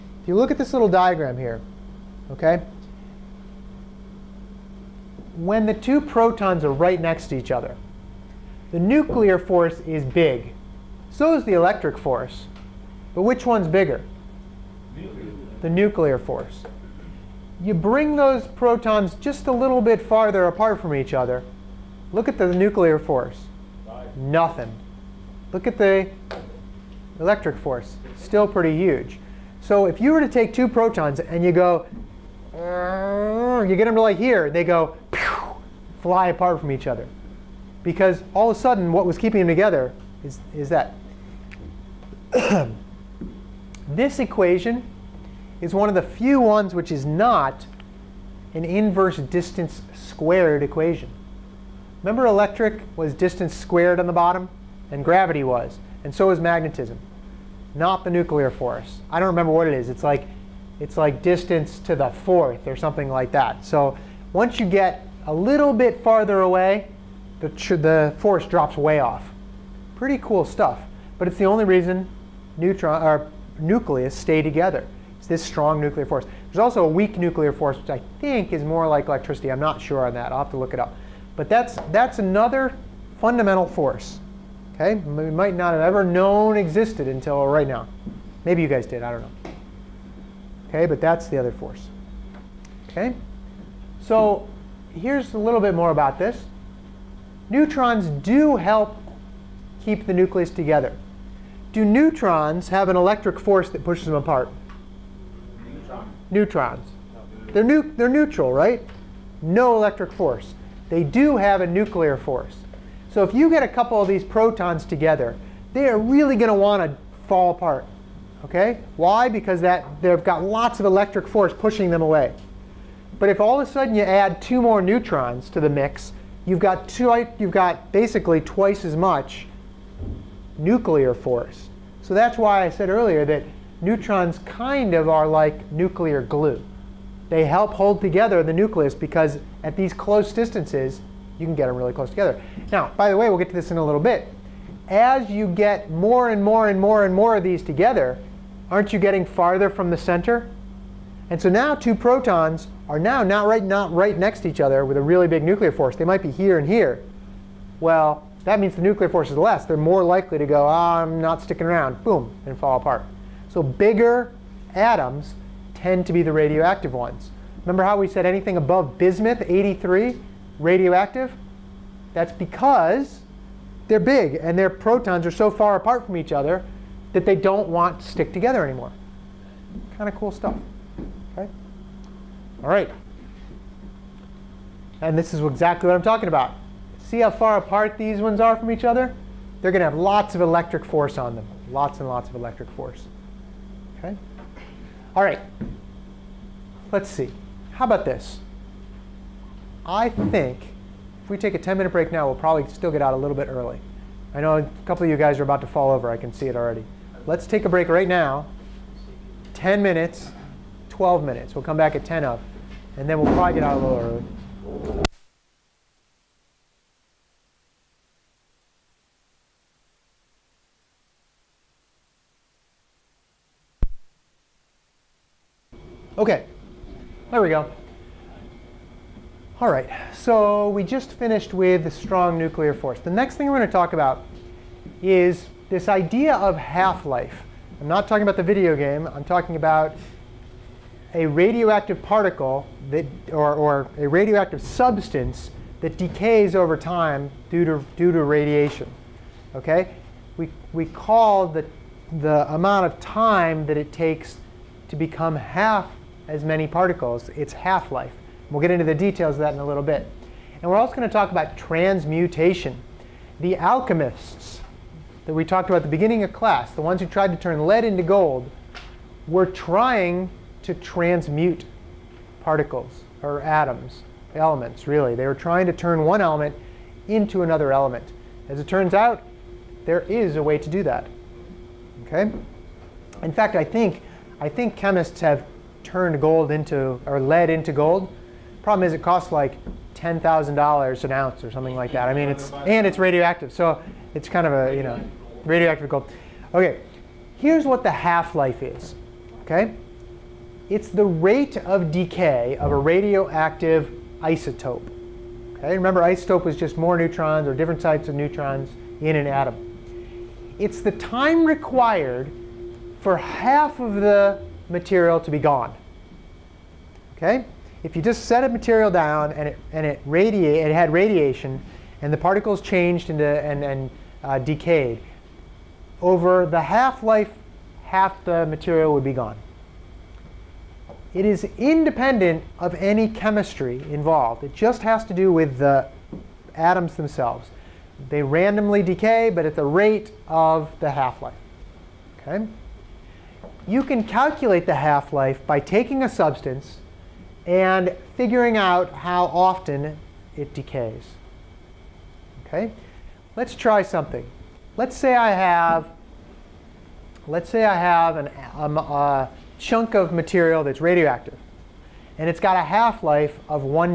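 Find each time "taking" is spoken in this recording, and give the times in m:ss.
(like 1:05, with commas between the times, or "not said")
5:45.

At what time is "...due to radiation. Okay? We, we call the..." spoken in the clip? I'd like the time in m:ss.
4:07.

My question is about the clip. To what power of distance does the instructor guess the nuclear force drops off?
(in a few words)
distance to the fourth.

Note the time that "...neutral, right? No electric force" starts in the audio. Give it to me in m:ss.
1:48.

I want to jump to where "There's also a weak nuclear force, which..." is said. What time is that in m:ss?
1:16.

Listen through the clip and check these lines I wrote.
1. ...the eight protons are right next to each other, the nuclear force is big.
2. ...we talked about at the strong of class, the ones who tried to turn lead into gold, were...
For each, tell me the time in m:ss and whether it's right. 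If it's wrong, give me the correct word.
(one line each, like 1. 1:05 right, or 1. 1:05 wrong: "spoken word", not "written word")
1. 0:05 wrong: "two", not "eight"
2. 4:25 wrong: "beginning", not "strong".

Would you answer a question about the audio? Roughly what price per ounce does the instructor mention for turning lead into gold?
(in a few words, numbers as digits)
$10,000.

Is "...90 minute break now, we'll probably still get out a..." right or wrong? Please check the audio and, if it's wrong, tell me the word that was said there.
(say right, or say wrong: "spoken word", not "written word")
wrong: "10", not "90".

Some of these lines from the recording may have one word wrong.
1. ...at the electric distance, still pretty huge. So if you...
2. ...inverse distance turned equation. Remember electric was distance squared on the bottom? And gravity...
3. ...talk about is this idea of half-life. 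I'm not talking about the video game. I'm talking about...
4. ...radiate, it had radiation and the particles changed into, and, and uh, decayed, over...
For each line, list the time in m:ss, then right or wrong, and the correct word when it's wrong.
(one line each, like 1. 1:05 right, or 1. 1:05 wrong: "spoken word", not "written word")
1. 0:25 wrong: "force", not "distance"
2. 0:48 wrong: "squared", not "turned"
3. 3:53 right
4. 5:20 right.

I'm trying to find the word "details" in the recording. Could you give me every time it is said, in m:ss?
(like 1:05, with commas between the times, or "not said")
4:18.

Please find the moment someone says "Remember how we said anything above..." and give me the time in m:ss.
2:47.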